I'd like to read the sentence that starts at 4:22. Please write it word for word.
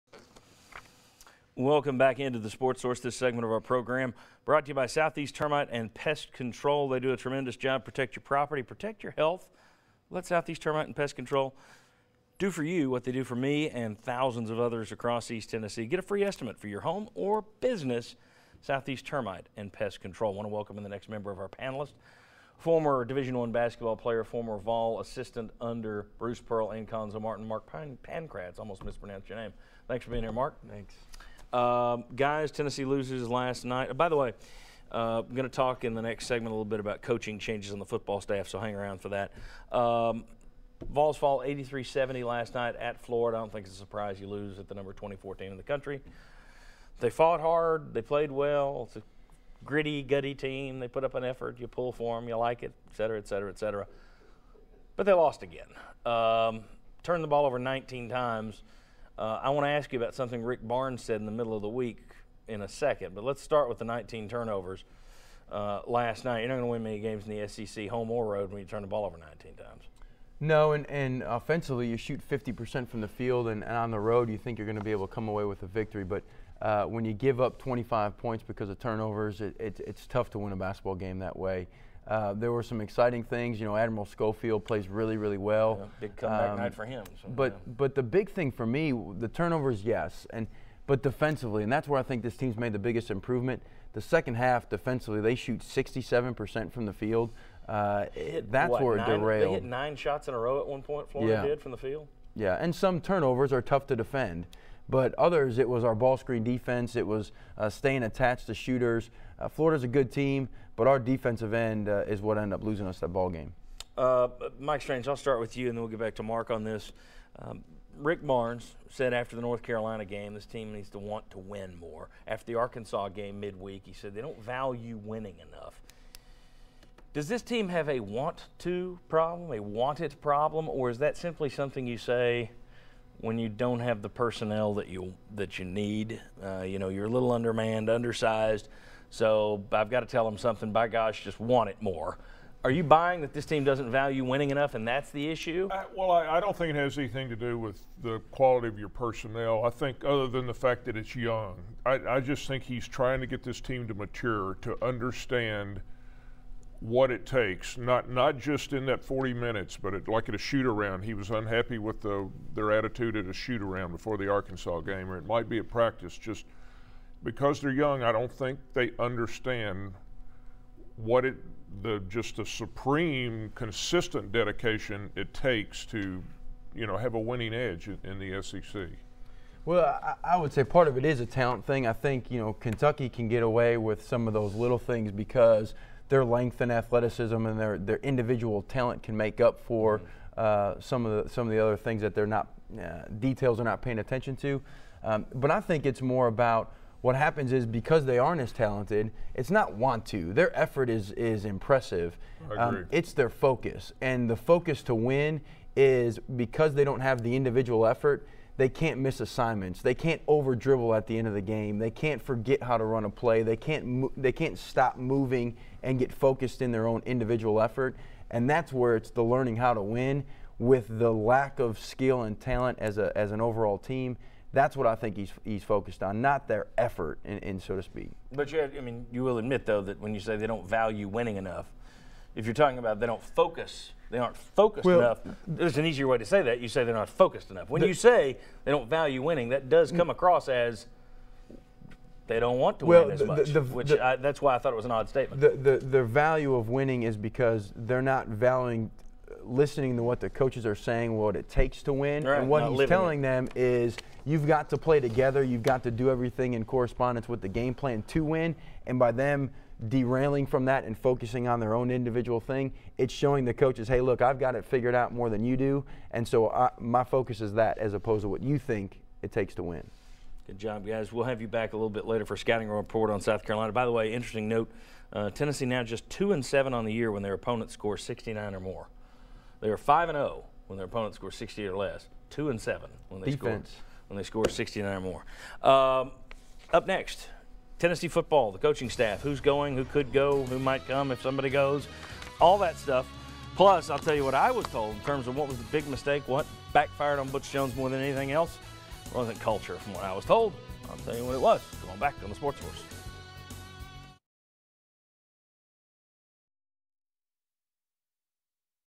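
It's showing the coaches, hey, look, I've got it figured out more than you do.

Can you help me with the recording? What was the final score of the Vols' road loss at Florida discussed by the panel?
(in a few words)
83-70.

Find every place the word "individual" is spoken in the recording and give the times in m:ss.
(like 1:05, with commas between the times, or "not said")
3:07, 3:27, 3:37, 4:21.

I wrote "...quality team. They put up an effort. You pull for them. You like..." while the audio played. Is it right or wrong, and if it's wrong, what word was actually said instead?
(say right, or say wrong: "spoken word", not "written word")
wrong: "gutty", not "quality".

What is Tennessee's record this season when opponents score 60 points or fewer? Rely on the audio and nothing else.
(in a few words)
5 and 0.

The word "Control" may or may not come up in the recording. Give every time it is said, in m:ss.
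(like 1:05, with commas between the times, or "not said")
0:06, 0:11, 0:19.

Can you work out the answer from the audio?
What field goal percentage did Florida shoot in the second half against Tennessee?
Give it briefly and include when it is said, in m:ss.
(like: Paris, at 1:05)
67%, at 1:35.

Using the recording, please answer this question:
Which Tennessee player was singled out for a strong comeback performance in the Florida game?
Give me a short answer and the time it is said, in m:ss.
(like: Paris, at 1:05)
Admiral Schofield, at 1:23.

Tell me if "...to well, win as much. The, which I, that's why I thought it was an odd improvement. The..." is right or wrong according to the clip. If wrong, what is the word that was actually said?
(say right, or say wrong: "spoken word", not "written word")
wrong: "statement", not "improvement".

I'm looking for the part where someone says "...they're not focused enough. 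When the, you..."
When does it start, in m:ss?
3:56.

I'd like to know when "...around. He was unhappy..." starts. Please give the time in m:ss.
2:40.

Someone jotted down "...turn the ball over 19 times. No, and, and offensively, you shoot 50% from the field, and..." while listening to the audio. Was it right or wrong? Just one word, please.
right.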